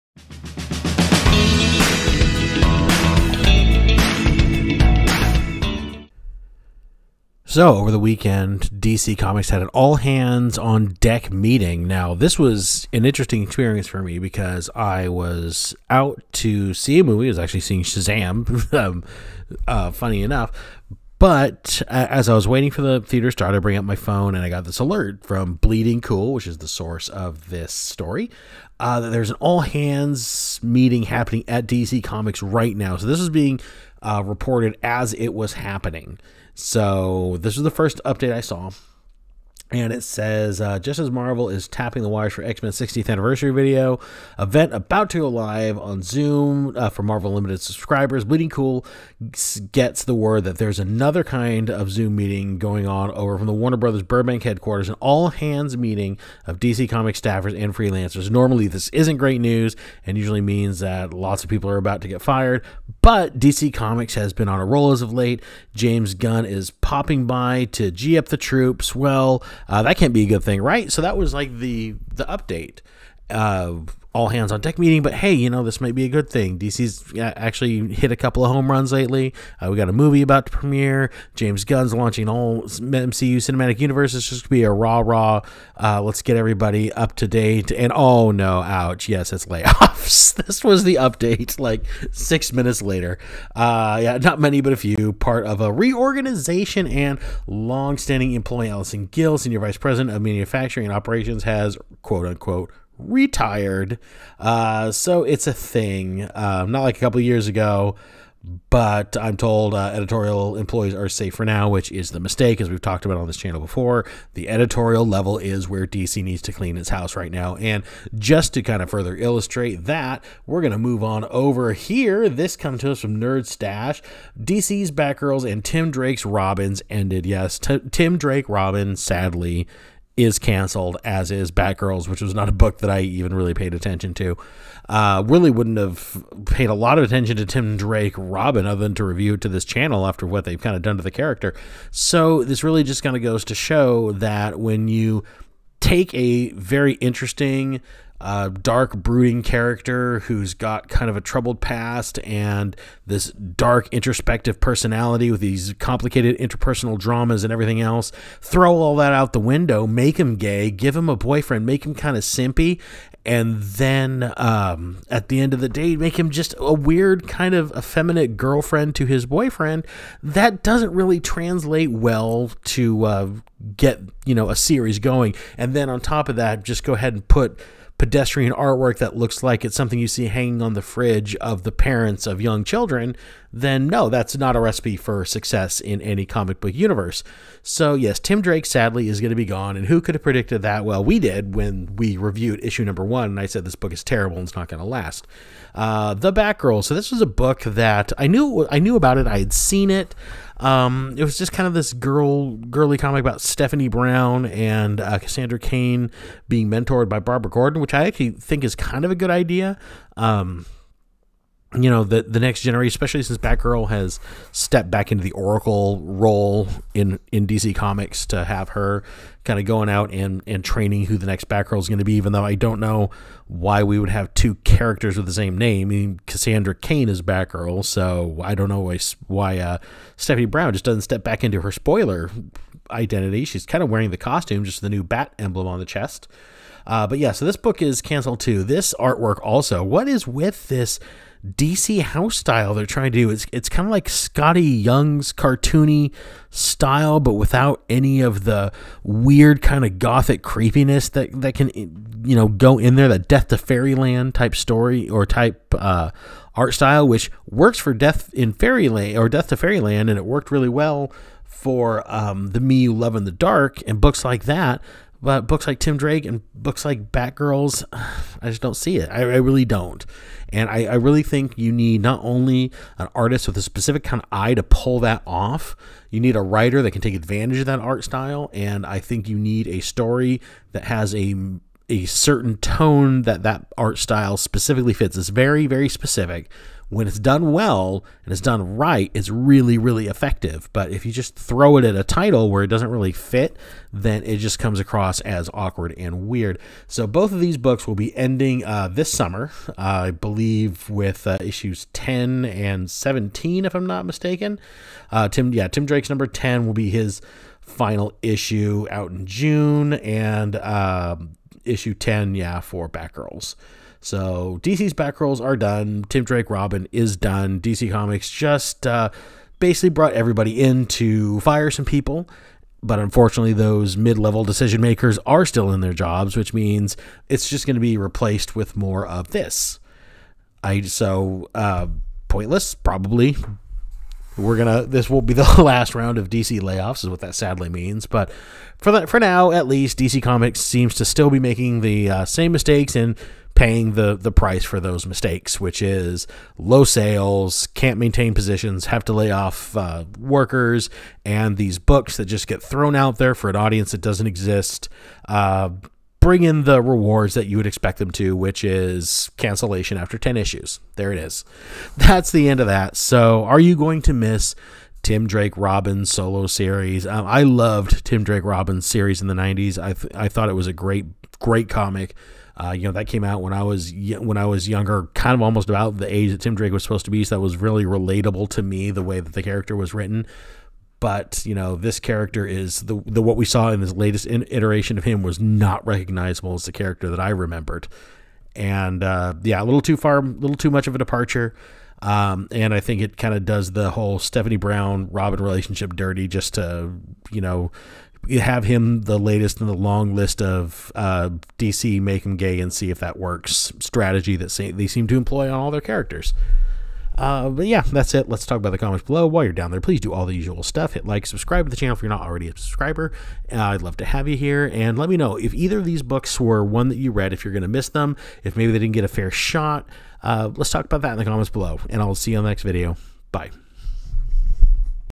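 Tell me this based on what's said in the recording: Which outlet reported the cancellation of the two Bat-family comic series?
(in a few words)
Nerd Stash.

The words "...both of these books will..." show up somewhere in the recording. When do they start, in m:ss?
4:57.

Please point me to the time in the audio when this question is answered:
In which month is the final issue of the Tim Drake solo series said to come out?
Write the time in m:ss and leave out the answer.
5:09.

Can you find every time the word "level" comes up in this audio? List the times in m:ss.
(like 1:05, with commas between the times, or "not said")
1:55, 5:24.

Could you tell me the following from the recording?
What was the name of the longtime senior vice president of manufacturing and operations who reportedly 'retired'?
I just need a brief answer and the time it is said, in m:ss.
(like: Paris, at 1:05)
Allison Gill, at 1:38.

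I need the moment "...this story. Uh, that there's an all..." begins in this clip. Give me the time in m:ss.
0:27.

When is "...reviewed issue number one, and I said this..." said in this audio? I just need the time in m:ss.
3:12.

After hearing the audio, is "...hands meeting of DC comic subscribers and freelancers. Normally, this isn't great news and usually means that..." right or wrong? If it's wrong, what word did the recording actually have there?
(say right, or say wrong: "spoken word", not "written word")
wrong: "staffers", not "subscribers".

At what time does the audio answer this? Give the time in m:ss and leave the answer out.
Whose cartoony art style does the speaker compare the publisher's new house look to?
4:04.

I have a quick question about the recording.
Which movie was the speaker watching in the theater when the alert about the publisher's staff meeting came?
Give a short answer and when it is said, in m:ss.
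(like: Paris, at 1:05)
Shazam, at 0:17.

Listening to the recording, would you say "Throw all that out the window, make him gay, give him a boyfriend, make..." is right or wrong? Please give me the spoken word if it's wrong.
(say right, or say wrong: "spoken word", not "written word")
right.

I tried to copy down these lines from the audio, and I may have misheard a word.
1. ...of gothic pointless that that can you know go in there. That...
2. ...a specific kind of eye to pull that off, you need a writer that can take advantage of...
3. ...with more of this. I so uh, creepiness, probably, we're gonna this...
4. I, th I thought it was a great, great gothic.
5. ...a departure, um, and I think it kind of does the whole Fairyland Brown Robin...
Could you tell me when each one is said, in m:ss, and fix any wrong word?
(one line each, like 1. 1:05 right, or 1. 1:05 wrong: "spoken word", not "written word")
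1. 4:09 wrong: "creepiness", not "pointless"
2. 4:33 right
3. 5:28 wrong: "pointless", not "creepiness"
4. 6:09 wrong: "comic", not "gothic"
5. 6:30 wrong: "Stephanie", not "Fairyland".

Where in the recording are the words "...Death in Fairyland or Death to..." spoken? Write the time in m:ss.
4:17.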